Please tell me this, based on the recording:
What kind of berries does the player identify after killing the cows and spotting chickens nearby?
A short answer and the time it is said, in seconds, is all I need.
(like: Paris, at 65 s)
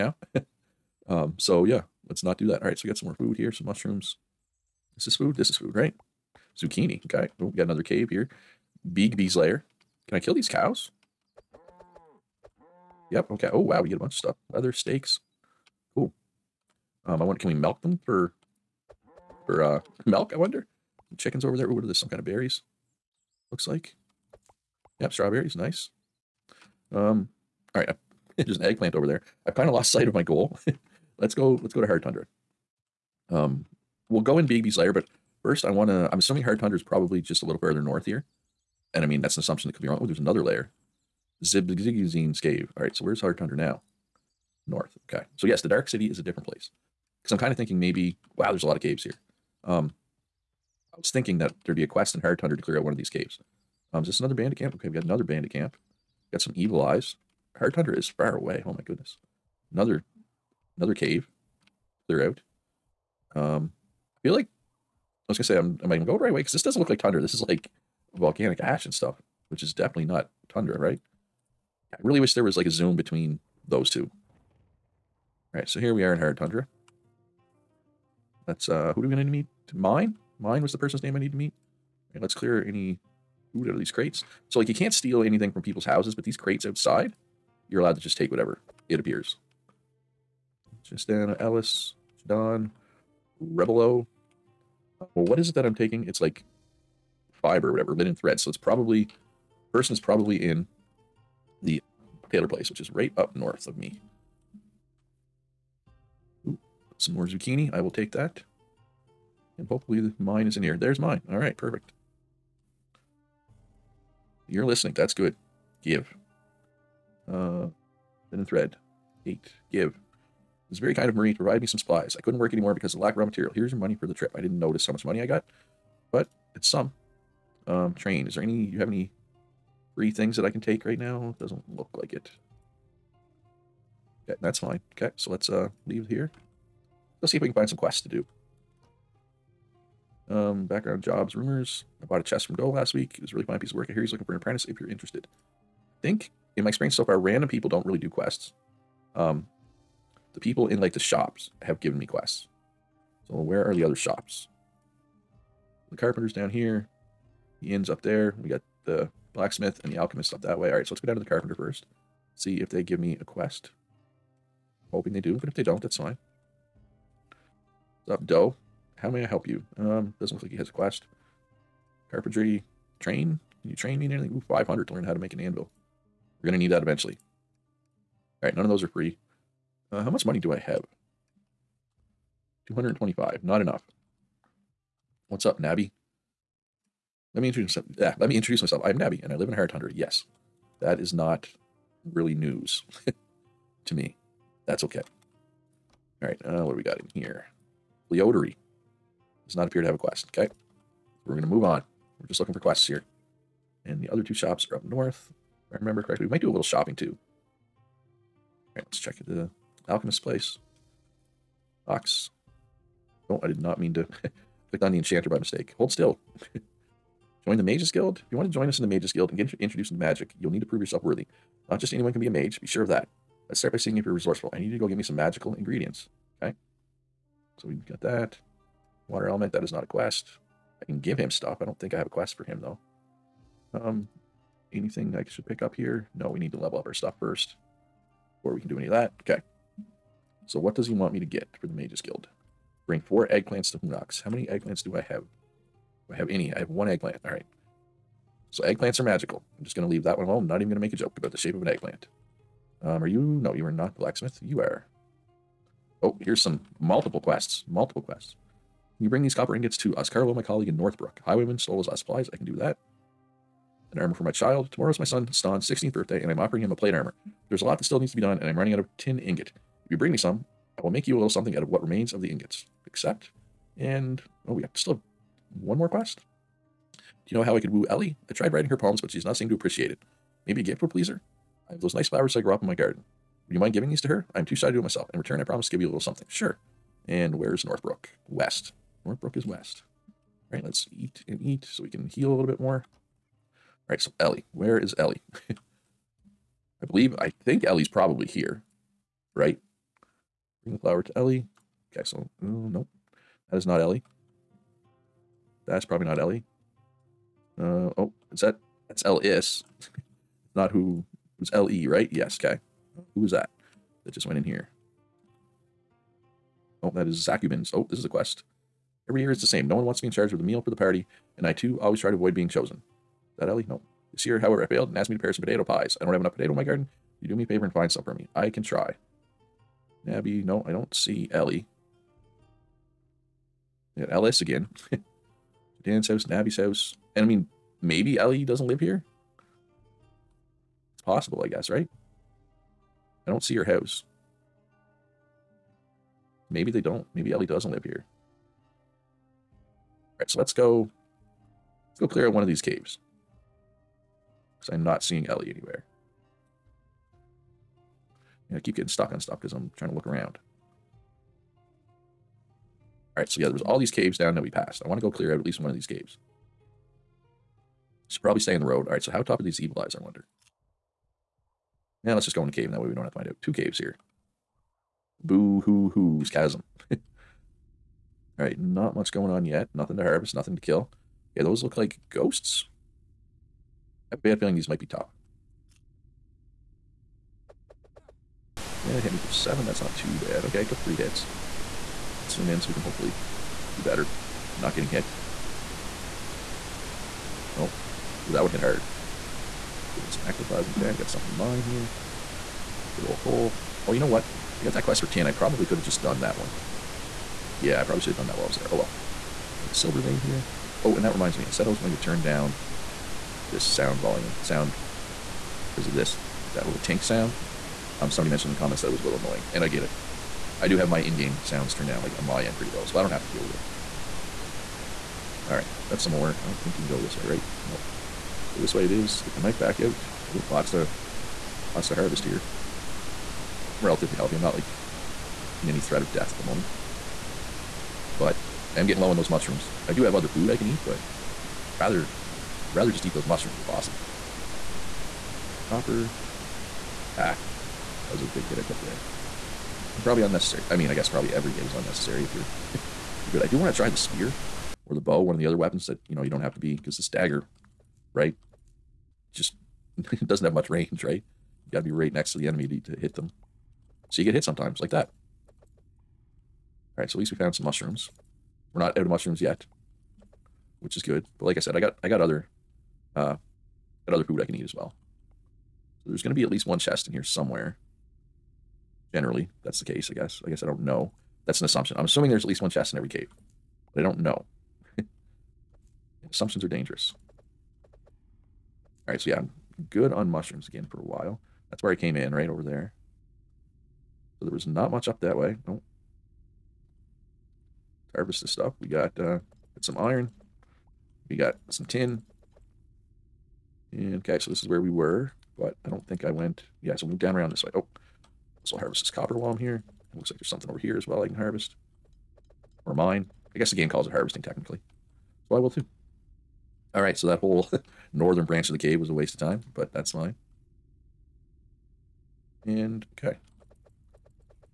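Strawberries, at 25 s.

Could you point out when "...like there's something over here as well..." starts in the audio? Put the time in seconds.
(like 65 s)
510 s.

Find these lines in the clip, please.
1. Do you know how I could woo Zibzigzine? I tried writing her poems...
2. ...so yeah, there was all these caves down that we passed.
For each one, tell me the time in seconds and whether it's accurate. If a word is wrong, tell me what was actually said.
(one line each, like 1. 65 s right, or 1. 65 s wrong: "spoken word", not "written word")
1. 276 s wrong: "Ellie", not "Zibzigzine"
2. 363 s right.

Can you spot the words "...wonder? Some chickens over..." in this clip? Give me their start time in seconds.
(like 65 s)
20 s.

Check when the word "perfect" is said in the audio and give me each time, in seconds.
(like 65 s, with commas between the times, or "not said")
111 s.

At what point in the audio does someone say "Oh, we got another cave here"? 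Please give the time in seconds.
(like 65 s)
7 s.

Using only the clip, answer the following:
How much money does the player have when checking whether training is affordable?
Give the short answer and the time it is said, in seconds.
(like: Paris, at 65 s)
225, at 182 s.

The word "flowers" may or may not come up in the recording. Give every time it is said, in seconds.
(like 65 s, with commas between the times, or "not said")
282 s, 300 s.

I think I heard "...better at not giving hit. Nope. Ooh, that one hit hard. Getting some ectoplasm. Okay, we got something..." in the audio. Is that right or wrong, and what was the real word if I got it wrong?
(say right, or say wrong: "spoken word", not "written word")
wrong: "getting", not "giving".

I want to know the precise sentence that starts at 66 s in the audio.
Because this doesn't look like tundra.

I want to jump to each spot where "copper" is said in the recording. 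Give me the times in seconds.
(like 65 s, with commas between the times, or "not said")
259 s, 445 s, 509 s.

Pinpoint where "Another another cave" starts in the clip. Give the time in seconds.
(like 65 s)
59 s.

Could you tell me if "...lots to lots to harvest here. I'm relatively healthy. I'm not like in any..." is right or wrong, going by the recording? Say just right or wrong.
right.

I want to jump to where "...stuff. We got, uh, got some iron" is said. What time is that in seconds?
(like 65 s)
498 s.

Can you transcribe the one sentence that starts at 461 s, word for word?
You got to be right next to the enemy to, to hit them.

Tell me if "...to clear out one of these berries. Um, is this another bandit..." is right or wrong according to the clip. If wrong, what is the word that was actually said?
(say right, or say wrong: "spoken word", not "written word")
wrong: "caves", not "berries".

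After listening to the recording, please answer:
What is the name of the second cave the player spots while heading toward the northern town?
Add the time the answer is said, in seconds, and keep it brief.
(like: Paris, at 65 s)
Zibzigzine's cave, at 41 s.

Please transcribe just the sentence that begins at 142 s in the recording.
I bought a chest from Doe last week.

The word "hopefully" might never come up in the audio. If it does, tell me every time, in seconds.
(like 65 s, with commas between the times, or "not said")
109 s, 392 s.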